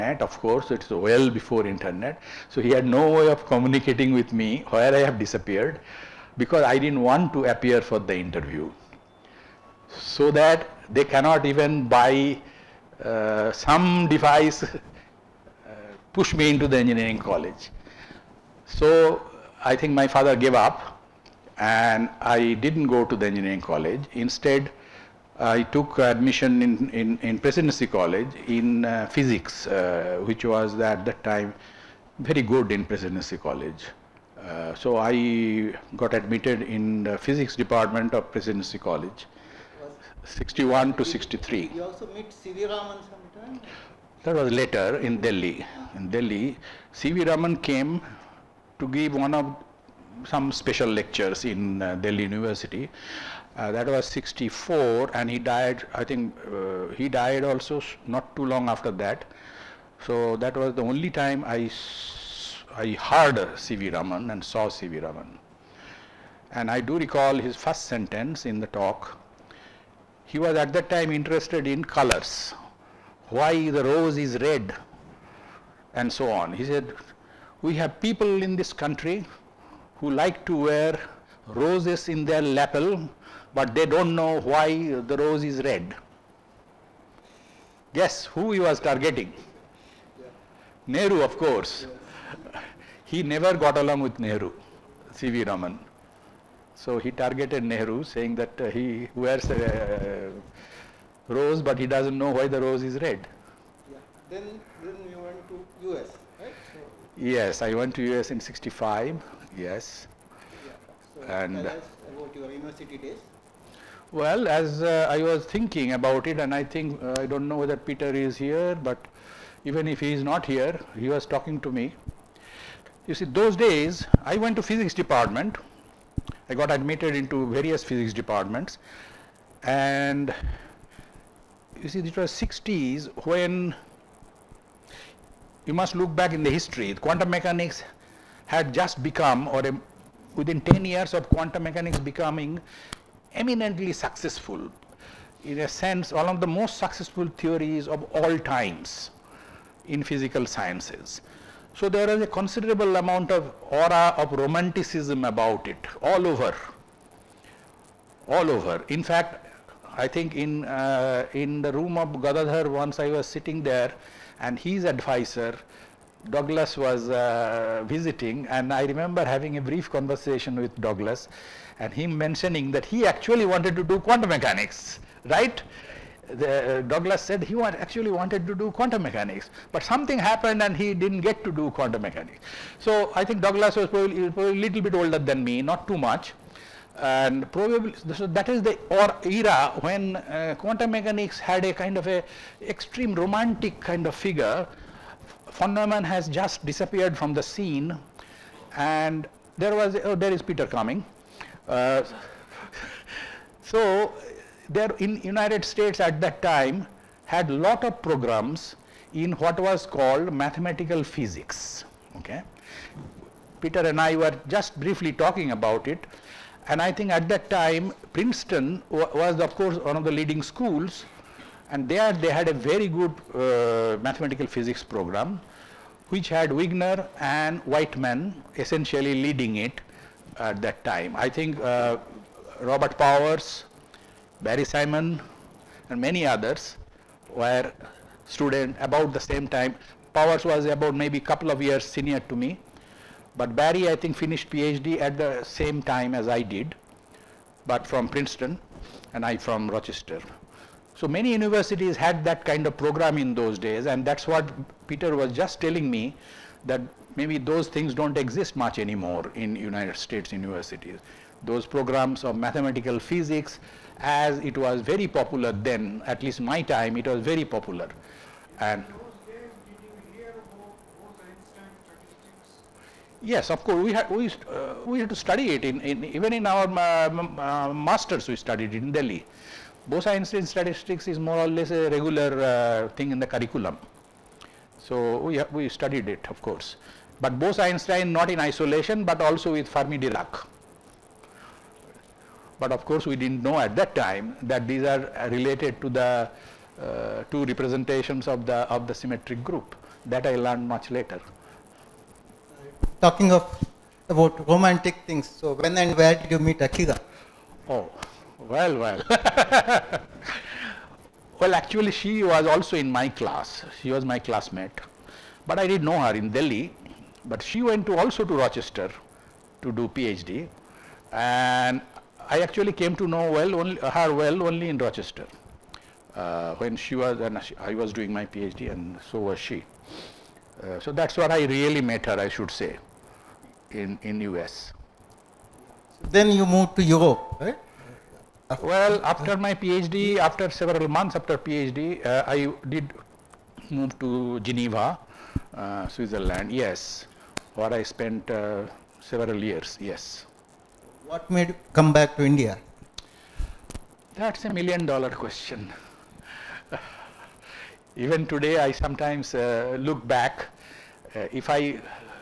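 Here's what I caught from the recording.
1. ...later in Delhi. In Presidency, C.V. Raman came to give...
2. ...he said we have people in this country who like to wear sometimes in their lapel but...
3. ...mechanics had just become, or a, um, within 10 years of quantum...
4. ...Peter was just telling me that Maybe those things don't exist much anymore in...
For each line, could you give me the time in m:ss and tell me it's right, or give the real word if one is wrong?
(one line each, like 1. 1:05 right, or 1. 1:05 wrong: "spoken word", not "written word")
1. 0:44 wrong: "Delhi", not "Presidency"
2. 1:16 wrong: "roses", not "sometimes"
3. 2:17 right
4. 4:14 right.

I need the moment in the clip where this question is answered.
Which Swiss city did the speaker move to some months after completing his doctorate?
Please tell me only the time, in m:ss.
5:44.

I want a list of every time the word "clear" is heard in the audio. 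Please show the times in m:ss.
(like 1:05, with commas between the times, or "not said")
not said.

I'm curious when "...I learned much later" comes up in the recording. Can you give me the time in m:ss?
5:00.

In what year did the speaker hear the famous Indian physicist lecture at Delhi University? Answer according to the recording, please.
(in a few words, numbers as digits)
1964.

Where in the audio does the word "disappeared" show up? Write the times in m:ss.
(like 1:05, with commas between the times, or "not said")
0:05, 3:16.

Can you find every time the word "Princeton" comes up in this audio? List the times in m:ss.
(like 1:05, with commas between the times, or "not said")
3:38, 4:08.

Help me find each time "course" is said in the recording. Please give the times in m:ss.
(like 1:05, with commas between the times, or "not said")
0:00, 1:31, 3:39, 4:33, 4:46, 4:52.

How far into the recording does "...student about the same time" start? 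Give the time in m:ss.
3:58.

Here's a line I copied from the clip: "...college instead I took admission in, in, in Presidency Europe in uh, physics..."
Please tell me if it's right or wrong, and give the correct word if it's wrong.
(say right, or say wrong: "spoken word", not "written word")
wrong: "College", not "Europe".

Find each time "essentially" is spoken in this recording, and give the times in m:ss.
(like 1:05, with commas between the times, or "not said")
3:48.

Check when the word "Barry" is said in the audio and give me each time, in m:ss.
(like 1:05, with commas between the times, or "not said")
3:54, 4:03.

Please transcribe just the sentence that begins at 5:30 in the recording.
Uh, so that's where I really met her I should say in, in US.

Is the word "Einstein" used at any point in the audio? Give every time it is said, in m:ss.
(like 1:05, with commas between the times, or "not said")
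4:39, 4:47.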